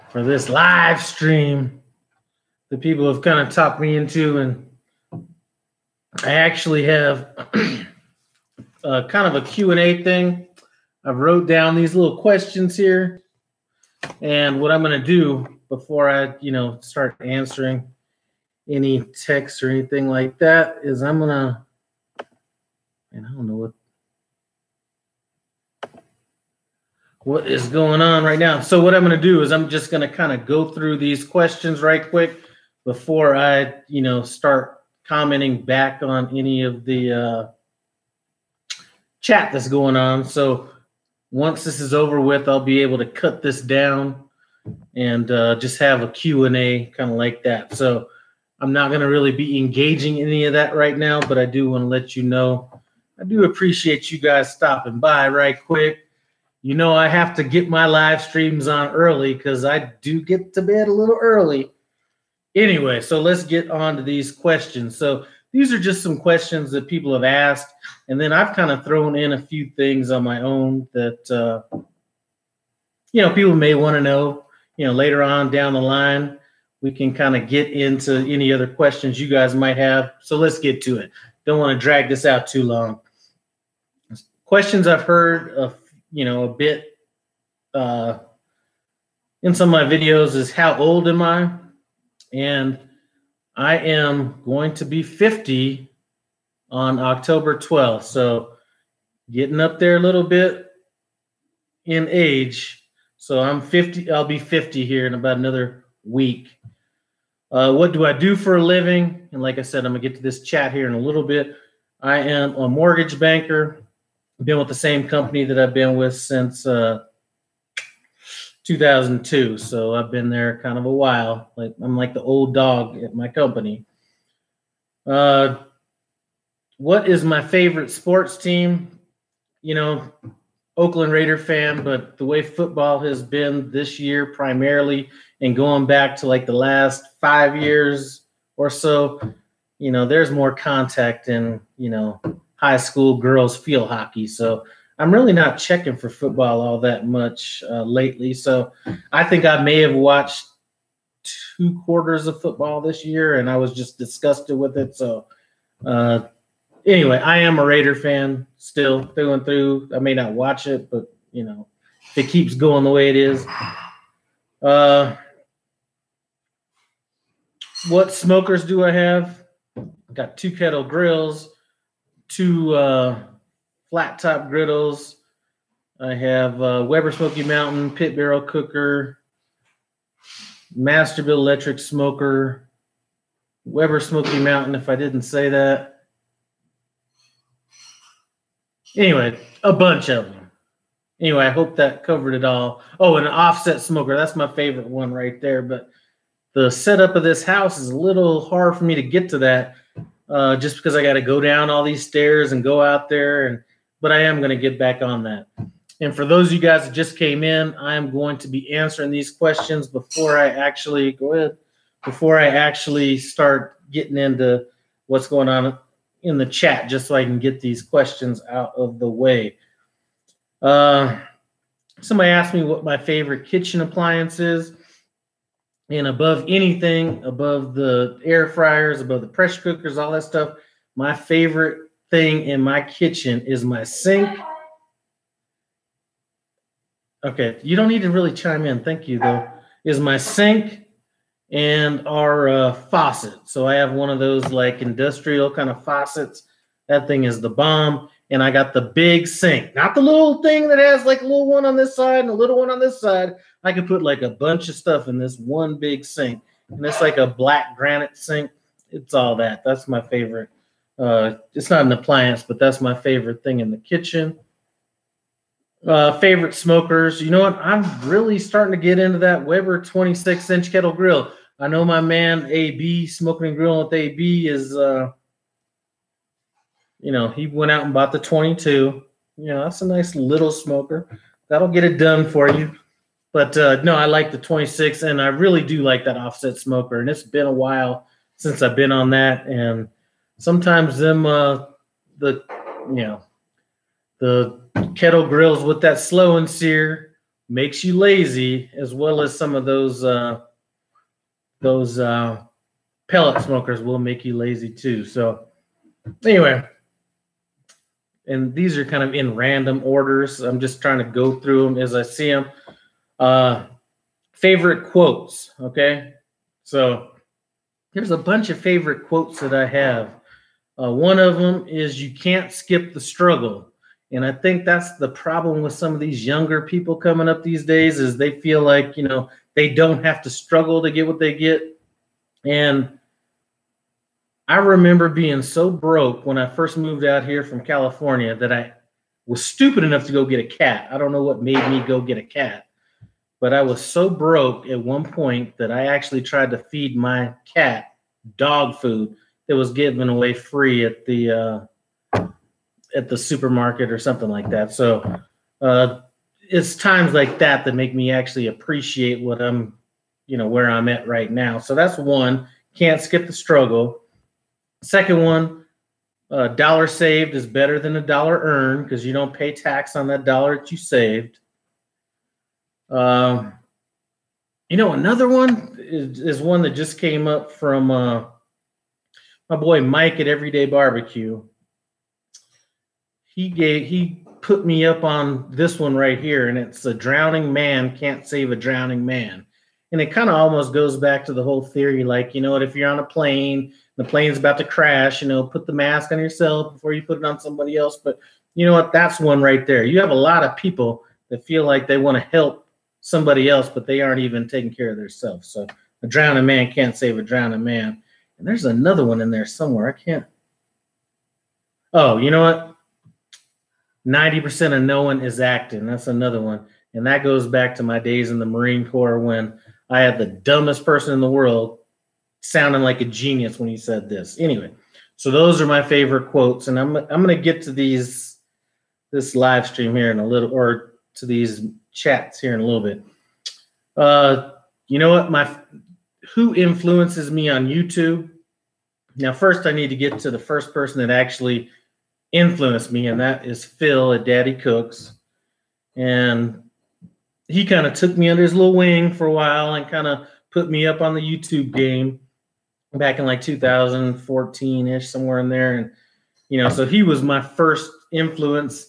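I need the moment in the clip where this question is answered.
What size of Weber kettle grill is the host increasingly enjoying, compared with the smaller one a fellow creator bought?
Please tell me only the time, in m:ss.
4:29.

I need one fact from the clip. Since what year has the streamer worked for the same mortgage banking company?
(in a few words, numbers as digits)
2002.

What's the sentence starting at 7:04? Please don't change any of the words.
Anyway, so those are my favorite quotes.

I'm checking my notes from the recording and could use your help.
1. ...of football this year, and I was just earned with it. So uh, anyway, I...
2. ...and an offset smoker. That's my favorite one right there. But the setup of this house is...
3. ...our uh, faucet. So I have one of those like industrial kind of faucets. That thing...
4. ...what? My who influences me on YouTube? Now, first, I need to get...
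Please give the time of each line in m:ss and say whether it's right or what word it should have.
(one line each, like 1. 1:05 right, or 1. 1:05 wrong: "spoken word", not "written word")
1. 2:32 wrong: "disgusted", not "earned"
2. 3:13 right
3. 4:02 right
4. 7:15 right.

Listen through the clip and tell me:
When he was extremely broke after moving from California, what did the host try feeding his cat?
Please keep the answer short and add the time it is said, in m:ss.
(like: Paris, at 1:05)
Dog food, at 5:48.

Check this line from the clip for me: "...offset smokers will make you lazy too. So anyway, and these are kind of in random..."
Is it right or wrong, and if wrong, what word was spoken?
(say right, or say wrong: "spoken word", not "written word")
wrong: "pellet", not "offset".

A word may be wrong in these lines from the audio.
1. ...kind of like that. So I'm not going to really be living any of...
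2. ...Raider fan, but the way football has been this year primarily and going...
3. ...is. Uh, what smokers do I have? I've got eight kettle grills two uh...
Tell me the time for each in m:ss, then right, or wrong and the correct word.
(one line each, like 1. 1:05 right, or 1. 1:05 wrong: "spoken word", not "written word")
1. 0:46 wrong: "engaging", not "living"
2. 2:11 right
3. 2:43 wrong: "two", not "eight".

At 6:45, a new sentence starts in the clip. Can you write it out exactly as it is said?
So a drowning man can't save a drowning man.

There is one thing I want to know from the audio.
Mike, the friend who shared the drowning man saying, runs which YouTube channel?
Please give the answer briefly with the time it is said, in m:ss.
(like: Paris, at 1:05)
Everyday Barbecue, at 6:20.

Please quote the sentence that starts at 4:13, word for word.
I could put like a bunch of stuff in this one big sink, and it's like a black granite sink.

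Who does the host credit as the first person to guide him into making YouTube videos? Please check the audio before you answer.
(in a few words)
Phil at Daddy Cooks.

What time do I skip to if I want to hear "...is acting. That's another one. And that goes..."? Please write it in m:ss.
6:55.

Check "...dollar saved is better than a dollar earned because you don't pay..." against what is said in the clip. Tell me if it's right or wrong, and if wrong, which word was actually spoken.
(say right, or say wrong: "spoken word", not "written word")
right.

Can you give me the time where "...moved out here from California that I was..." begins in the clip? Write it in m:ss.
5:36.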